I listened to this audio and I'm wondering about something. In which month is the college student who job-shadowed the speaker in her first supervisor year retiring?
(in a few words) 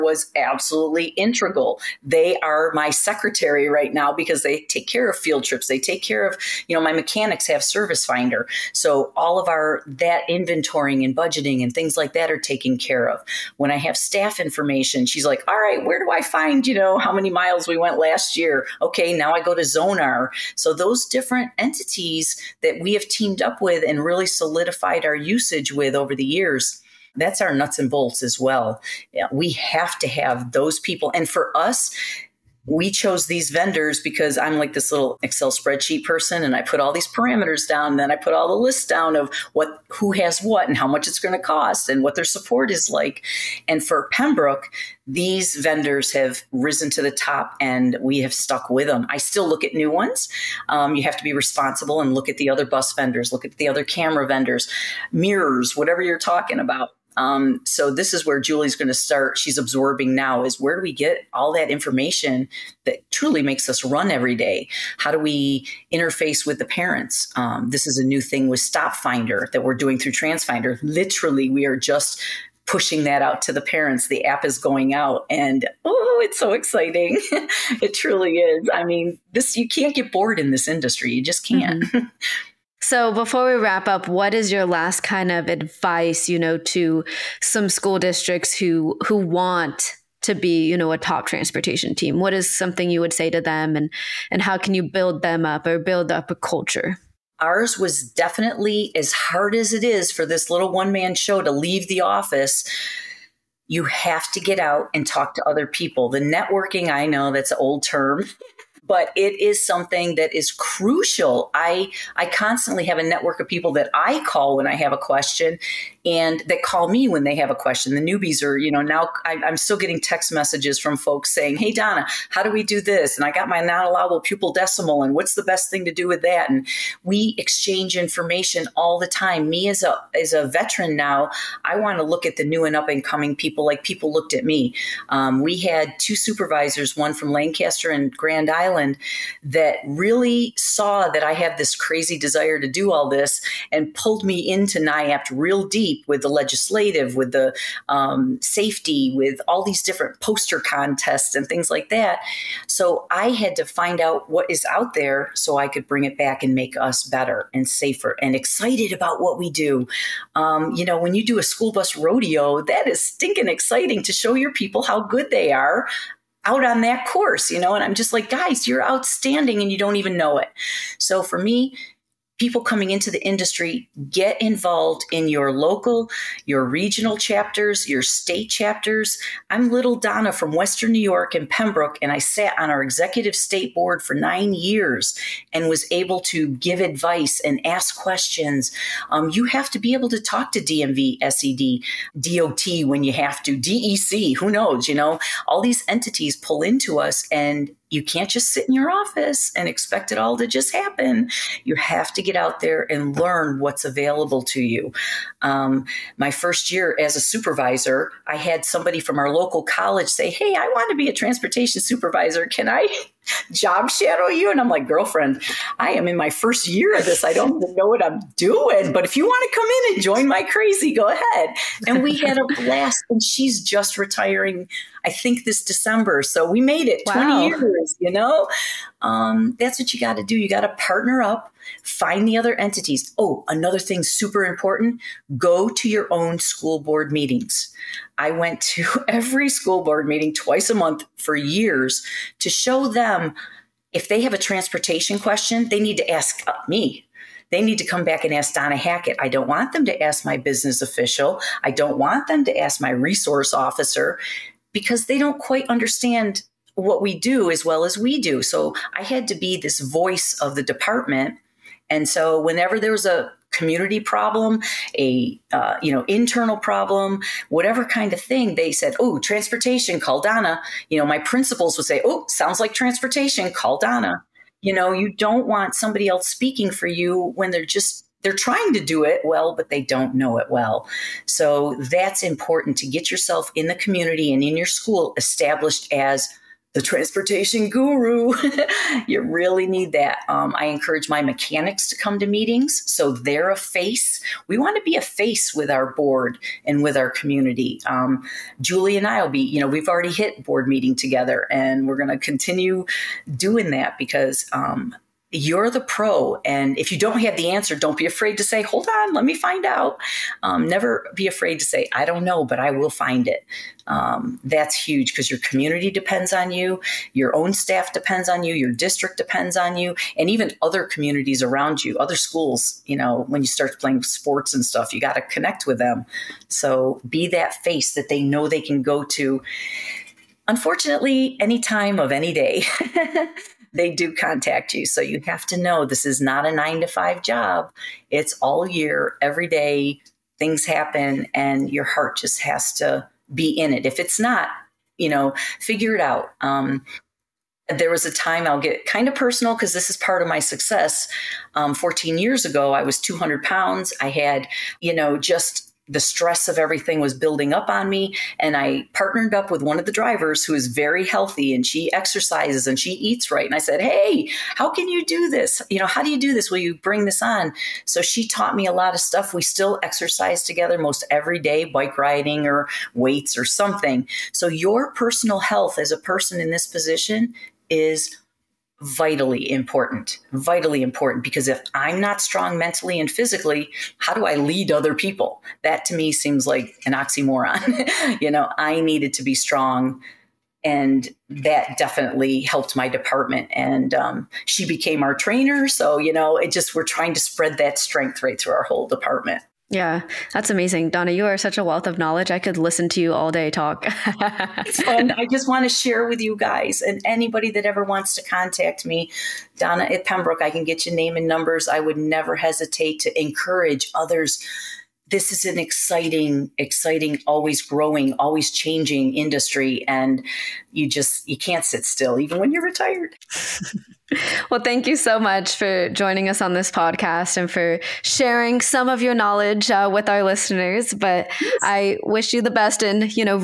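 December.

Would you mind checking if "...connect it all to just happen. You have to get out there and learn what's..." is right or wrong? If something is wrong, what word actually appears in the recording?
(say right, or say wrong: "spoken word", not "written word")
wrong: "expect", not "connect".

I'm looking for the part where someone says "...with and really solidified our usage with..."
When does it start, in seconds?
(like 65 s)
23 s.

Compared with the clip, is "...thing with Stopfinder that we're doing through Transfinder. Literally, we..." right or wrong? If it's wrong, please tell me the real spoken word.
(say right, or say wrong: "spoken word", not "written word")
right.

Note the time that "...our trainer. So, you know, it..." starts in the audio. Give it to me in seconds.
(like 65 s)
395 s.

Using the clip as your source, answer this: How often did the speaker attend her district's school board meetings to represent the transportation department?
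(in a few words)
twice a month.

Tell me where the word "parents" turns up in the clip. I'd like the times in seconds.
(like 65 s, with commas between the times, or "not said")
66 s, 73 s.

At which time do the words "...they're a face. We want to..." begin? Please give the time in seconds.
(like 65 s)
293 s.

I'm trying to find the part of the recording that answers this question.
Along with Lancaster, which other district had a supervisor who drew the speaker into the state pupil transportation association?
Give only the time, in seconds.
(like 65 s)
138 s.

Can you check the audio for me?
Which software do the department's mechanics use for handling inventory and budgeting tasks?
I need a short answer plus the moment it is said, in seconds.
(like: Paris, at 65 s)
Servicefinder, at 7 s.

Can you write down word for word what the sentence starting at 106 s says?
The networking, I know that's an old term, but it is something that is crucial.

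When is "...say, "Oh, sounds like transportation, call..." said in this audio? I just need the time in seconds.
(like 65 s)
271 s.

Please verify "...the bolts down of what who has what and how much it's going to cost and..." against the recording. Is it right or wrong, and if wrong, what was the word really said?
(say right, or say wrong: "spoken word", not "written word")
wrong: "lists", not "bolts".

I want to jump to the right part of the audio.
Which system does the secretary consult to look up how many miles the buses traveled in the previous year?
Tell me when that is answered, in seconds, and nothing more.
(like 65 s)
19 s.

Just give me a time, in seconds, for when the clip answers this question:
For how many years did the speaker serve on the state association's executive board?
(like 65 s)
184 s.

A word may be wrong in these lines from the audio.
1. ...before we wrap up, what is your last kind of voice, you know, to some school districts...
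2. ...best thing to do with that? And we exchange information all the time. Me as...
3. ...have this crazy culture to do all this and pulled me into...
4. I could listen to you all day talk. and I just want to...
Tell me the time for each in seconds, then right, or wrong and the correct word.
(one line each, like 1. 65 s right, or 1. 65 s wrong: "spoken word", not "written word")
1. 83 s wrong: "advice", not "voice"
2. 125 s right
3. 141 s wrong: "desire", not "culture"
4. 402 s right.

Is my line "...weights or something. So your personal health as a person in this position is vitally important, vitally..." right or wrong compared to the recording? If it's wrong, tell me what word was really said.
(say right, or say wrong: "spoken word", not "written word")
right.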